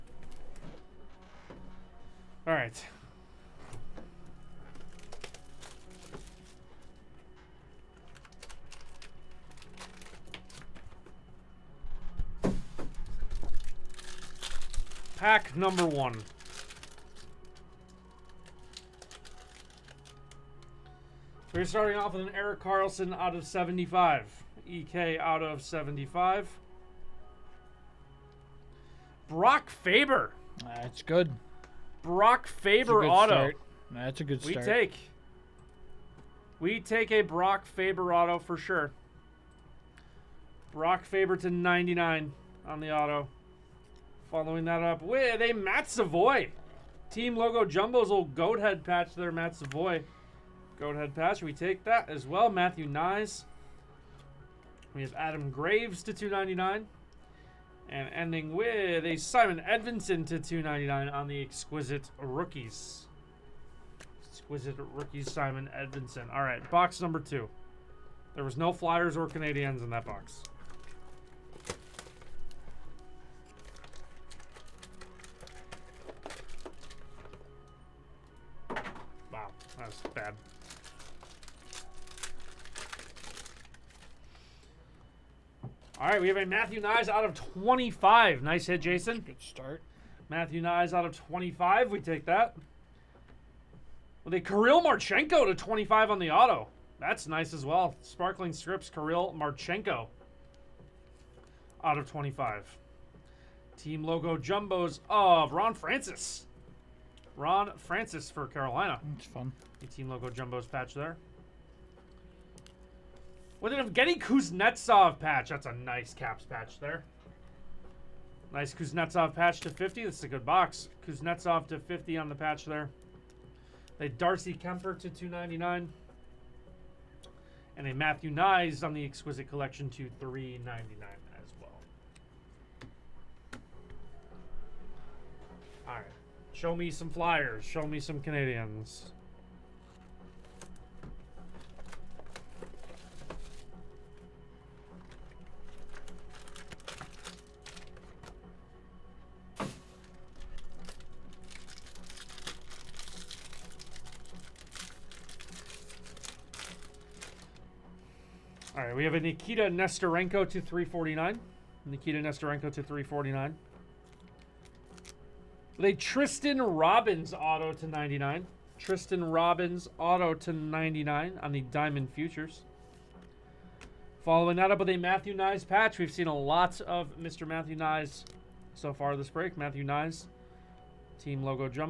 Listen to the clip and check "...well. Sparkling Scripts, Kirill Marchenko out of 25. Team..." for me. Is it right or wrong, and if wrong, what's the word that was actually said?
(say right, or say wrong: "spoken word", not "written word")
right.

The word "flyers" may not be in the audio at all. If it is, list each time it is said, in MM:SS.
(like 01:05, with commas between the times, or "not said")
01:08, 02:17.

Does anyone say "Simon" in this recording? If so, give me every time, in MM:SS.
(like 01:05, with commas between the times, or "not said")
00:59, 01:05.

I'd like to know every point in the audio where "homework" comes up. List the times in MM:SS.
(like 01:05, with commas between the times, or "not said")
not said.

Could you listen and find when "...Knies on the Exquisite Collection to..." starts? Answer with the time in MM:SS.
02:08.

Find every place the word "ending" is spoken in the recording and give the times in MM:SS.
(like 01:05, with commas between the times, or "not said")
00:58.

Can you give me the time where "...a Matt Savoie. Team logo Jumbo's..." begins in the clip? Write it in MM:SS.
00:45.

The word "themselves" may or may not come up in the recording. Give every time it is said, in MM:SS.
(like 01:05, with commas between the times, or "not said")
not said.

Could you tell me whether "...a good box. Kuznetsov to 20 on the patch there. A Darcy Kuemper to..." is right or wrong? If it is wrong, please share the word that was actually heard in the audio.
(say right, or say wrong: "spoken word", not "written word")
wrong: "50", not "20".